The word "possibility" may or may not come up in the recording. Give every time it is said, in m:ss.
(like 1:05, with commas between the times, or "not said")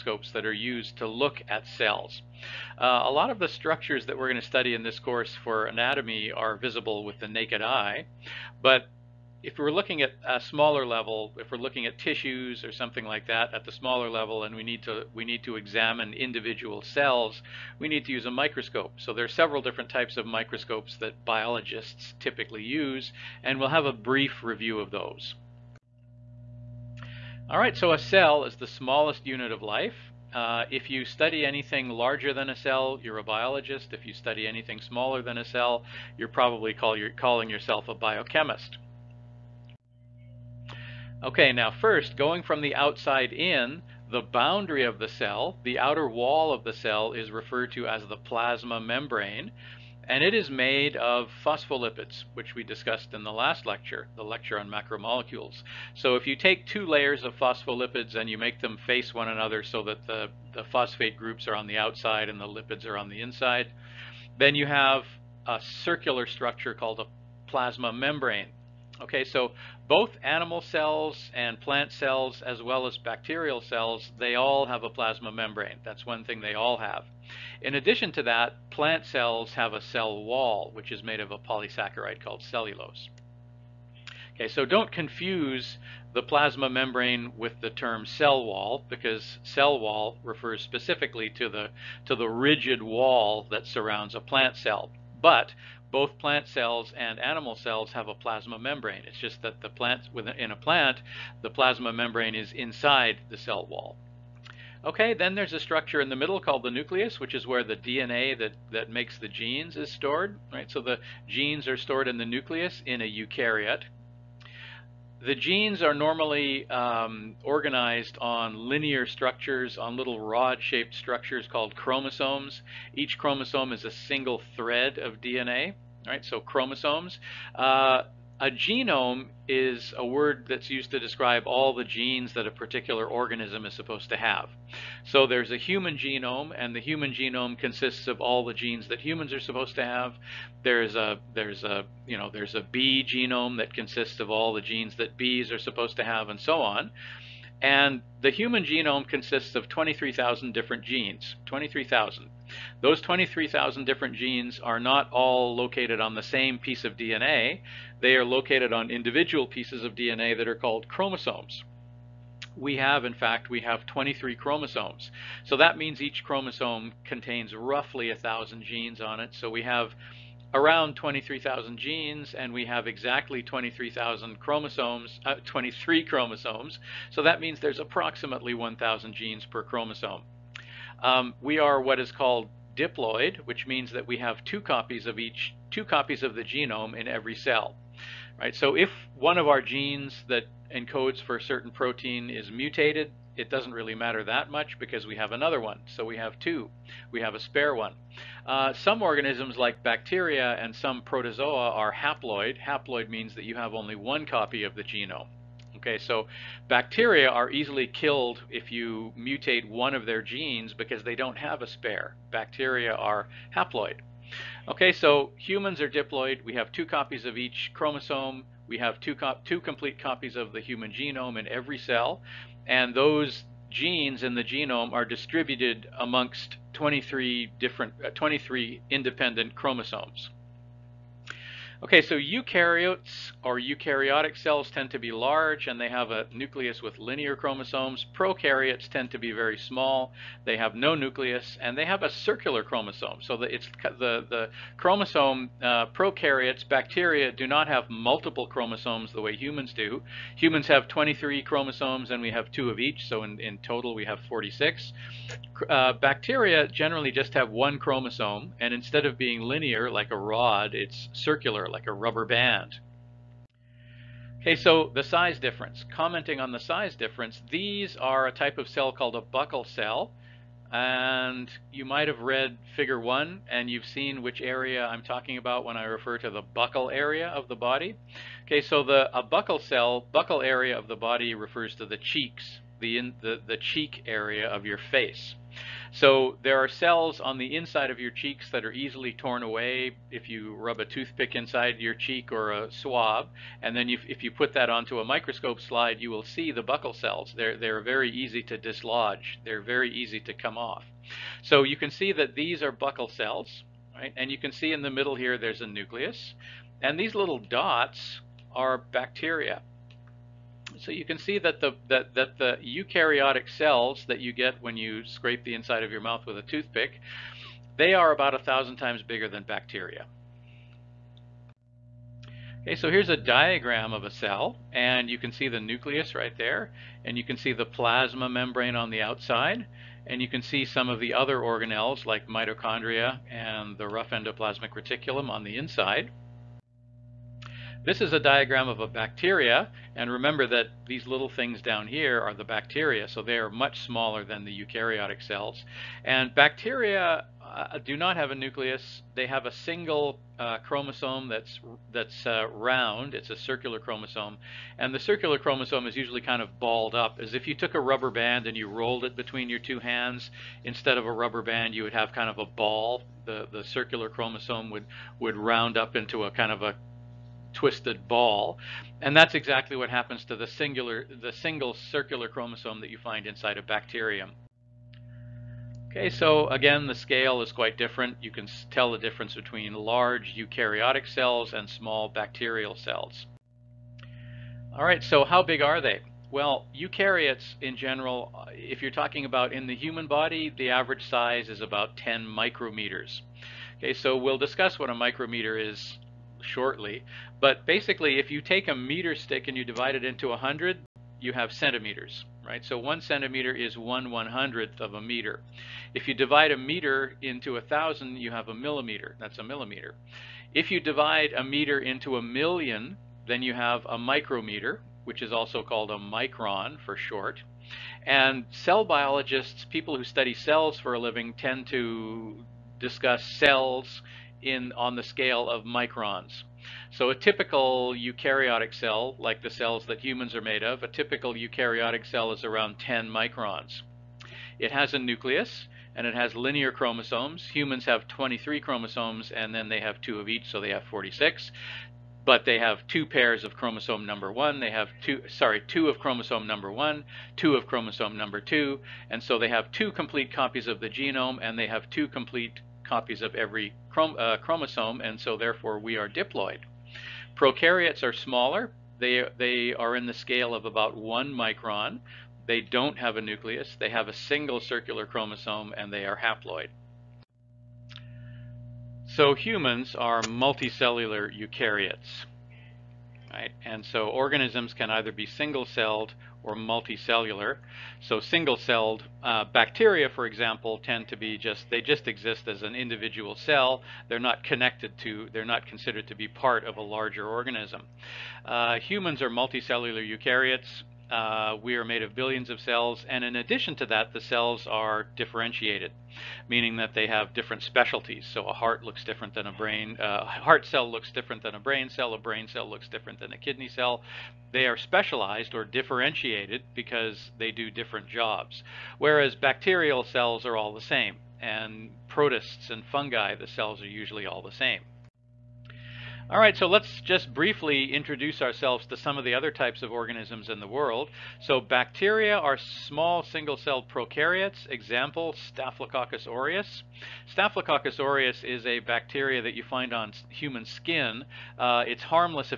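not said.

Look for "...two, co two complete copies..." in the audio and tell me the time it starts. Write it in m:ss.
3:38.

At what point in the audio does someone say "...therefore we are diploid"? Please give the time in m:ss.
7:35.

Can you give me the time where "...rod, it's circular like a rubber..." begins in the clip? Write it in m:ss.
4:20.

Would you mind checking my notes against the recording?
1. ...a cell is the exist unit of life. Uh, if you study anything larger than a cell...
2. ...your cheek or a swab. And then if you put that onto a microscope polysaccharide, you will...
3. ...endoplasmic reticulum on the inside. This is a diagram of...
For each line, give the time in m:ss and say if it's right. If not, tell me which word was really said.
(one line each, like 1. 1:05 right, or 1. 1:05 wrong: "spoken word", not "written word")
1. 0:27 wrong: "smallest", not "exist"
2. 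4:51 wrong: "slide", not "polysaccharide"
3. 5:34 right.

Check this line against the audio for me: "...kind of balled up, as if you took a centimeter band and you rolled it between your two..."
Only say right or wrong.
wrong.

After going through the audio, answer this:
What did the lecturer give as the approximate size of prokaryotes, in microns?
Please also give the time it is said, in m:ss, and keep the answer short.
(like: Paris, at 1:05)
1 micron, at 7:40.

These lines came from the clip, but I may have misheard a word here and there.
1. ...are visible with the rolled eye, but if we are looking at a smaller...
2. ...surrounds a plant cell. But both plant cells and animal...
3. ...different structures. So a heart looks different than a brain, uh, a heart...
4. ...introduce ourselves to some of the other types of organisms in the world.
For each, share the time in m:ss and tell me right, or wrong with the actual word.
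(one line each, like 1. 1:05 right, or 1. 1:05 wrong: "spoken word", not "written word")
1. 0:06 wrong: "naked", not "rolled"
2. 1:33 right
3. 8:17 wrong: "specialties", not "structures"
4. 8:37 right.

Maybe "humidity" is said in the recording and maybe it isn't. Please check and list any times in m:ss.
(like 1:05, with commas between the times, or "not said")
not said.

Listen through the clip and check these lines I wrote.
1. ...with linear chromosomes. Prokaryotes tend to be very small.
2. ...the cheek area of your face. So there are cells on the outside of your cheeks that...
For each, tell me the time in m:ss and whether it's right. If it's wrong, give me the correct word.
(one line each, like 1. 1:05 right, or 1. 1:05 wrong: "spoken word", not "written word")
1. 3:56 right
2. 4:43 wrong: "inside", not "outside".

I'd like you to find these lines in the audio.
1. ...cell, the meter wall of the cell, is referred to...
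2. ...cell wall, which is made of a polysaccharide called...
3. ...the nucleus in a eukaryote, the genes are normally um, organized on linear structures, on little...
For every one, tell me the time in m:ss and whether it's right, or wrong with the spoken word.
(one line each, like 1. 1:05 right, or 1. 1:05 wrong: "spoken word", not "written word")
1. 0:45 wrong: "outer", not "meter"
2. 1:19 right
3. 1:52 right.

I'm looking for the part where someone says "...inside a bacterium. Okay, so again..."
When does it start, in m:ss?
6:13.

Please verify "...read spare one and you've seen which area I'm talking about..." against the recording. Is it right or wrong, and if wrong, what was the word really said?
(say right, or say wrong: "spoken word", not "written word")
wrong: "figure", not "spare".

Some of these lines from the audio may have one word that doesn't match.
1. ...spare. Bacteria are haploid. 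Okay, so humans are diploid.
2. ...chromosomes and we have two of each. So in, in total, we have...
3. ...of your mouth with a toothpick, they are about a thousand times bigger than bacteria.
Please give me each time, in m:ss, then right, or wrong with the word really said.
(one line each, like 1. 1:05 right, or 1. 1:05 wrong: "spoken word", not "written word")
1. 3:31 right
2. 4:11 right
3. 5:15 right.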